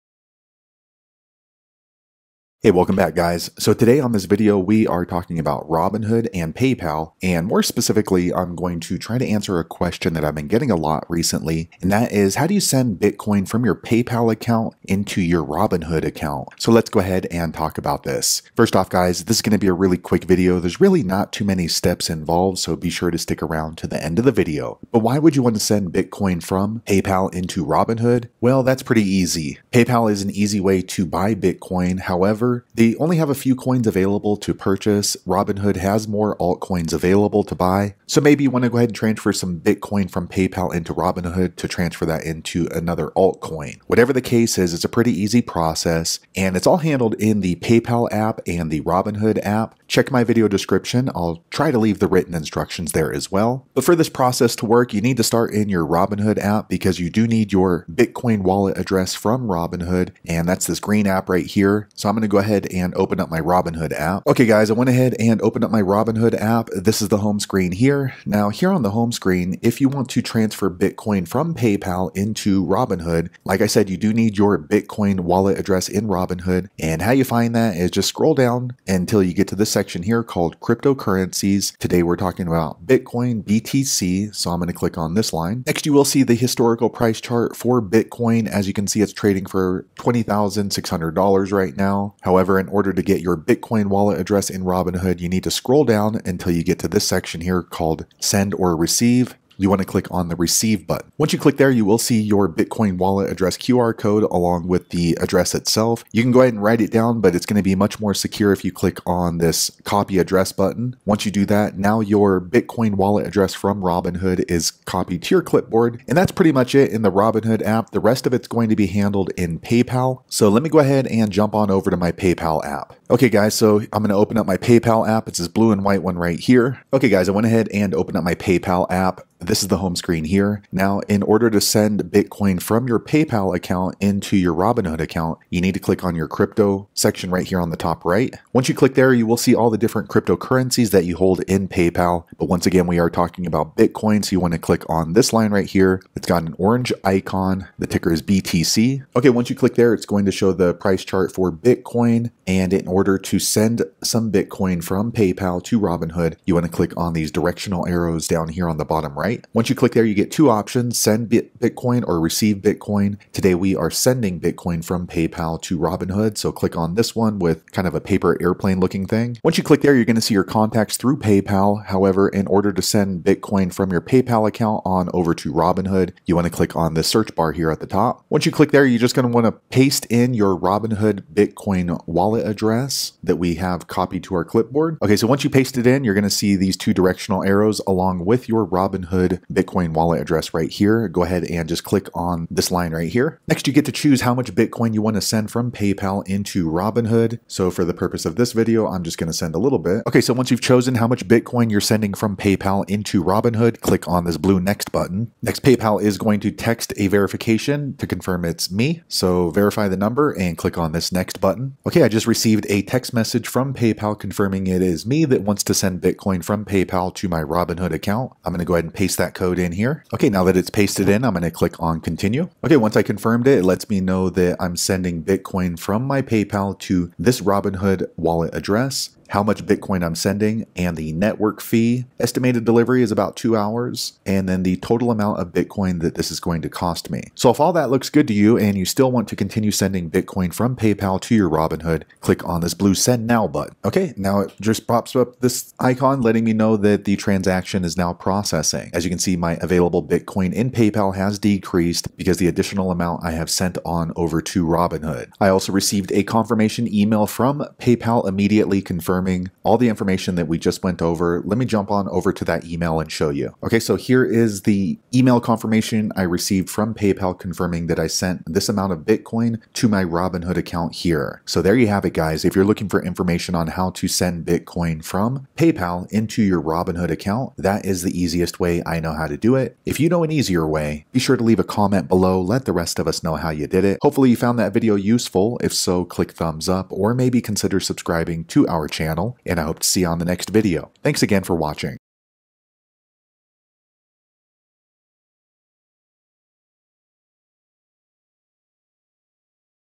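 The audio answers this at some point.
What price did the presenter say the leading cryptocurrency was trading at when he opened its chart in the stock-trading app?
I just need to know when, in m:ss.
1:29.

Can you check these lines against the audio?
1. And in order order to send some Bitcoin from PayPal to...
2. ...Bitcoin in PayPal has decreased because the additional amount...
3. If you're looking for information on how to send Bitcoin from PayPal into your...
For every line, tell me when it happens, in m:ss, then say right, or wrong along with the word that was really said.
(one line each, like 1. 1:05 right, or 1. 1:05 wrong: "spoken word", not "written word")
1. 2:32 right
2. 4:10 right
3. 4:32 right.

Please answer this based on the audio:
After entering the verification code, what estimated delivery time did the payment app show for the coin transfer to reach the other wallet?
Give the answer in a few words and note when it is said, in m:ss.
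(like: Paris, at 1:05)
About two hours, at 3:53.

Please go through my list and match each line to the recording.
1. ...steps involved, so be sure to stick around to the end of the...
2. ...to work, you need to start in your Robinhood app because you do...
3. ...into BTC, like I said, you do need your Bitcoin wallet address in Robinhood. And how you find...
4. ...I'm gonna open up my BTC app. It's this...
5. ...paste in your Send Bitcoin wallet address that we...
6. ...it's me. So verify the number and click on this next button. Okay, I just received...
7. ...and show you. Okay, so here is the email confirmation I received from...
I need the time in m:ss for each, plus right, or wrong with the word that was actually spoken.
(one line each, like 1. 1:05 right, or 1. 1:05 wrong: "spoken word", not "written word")
1. 0:21 right
2. 0:54 right
3. 1:12 wrong: "Robinhood", not "BTC"
4. 2:03 wrong: "PayPal", not "BTC"
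5. 2:59 wrong: "Robinhood", not "Send"
6. 3:28 right
7. 4:22 right.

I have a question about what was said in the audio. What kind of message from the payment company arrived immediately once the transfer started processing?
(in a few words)
Confirmation email.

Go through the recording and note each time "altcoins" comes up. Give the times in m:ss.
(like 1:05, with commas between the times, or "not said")
0:36, 0:43.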